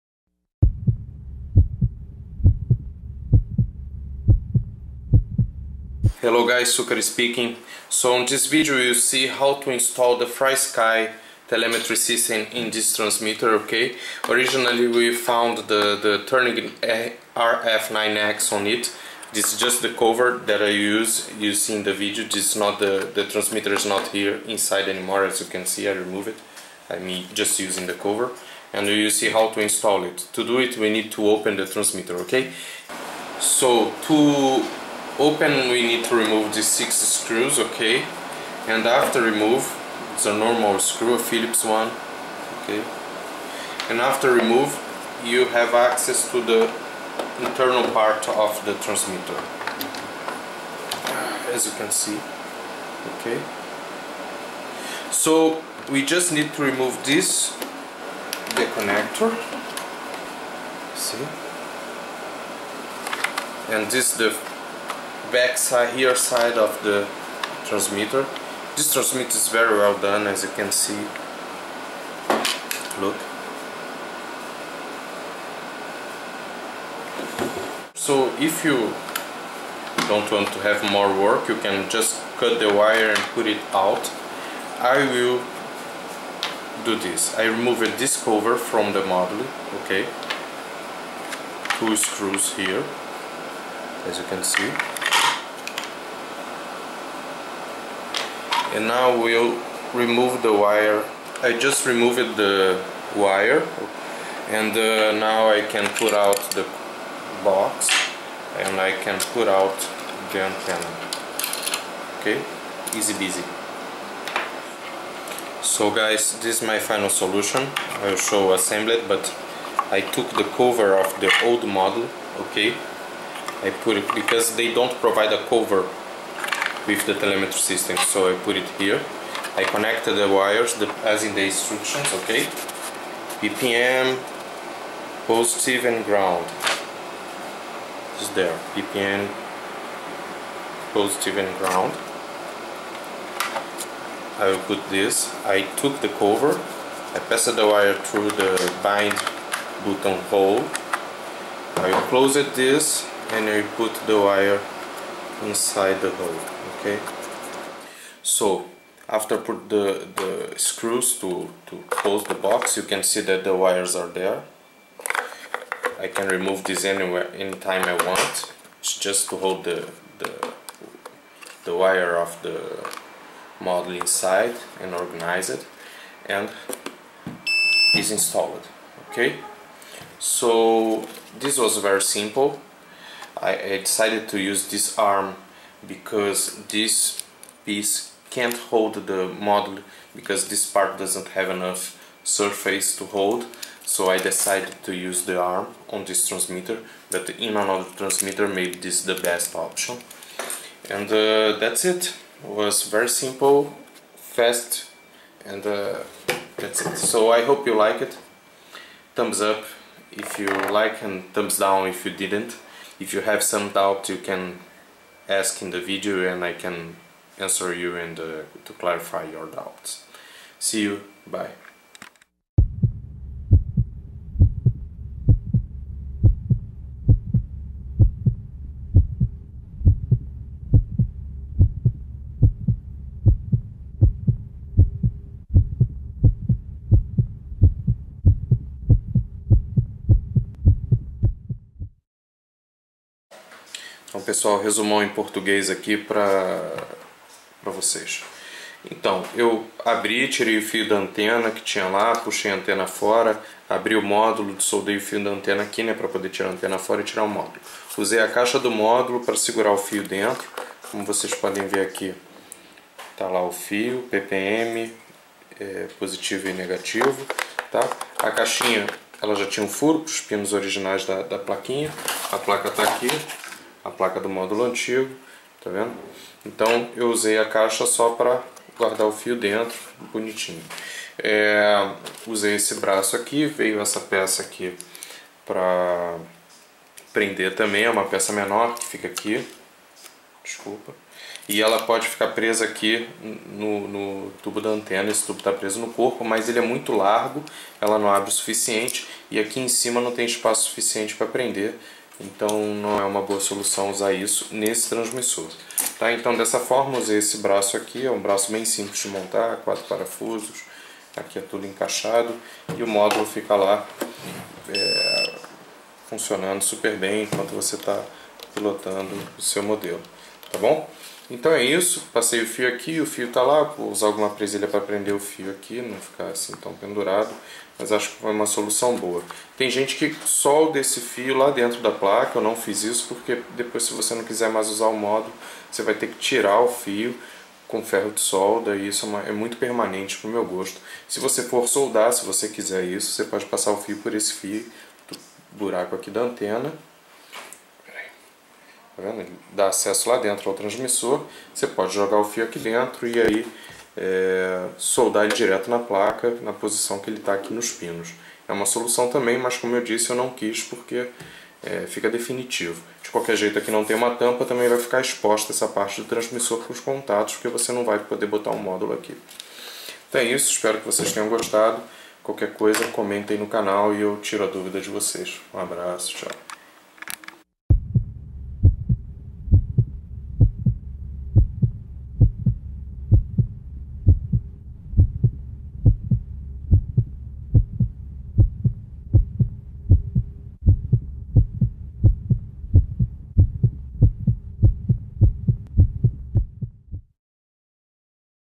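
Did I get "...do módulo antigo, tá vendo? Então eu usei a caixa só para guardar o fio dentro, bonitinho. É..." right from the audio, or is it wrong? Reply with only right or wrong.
right.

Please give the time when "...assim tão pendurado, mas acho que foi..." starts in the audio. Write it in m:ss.
5:26.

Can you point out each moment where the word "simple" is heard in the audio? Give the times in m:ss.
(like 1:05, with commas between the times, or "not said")
3:02, 3:23, 5:08.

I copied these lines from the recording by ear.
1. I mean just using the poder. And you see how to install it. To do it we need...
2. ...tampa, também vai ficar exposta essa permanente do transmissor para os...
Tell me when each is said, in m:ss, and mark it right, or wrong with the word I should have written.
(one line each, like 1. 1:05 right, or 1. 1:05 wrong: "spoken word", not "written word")
1. 0:26 wrong: "cover", not "poder"
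2. 6:04 wrong: "parte", not "permanente".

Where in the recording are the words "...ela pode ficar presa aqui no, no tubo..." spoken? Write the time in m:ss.
4:51.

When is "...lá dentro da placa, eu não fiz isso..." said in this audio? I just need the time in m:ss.
5:31.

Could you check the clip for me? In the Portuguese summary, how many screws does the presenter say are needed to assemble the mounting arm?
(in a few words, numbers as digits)
4.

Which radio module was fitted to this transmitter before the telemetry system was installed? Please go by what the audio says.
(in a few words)
Turnigy RF9X.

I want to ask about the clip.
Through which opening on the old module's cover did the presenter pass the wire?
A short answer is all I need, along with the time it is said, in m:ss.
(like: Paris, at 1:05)
bind button hole, at 2:28.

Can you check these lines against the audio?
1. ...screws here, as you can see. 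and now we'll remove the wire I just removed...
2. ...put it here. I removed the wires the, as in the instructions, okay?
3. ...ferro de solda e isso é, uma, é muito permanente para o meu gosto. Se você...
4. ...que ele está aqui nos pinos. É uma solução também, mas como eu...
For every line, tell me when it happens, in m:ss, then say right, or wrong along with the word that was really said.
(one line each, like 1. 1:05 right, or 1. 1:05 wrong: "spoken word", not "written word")
1. 1:31 right
2. 2:08 wrong: "connected", not "removed"
3. 5:37 right
4. 5:56 right.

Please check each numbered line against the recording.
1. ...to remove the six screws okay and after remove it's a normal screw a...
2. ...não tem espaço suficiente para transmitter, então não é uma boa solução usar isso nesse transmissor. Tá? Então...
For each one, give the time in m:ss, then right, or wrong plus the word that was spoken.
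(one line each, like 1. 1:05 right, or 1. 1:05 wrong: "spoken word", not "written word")
1. 0:36 right
2. 4:59 wrong: "prender", not "transmitter".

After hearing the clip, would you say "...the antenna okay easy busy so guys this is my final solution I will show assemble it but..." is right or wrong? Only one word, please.
right.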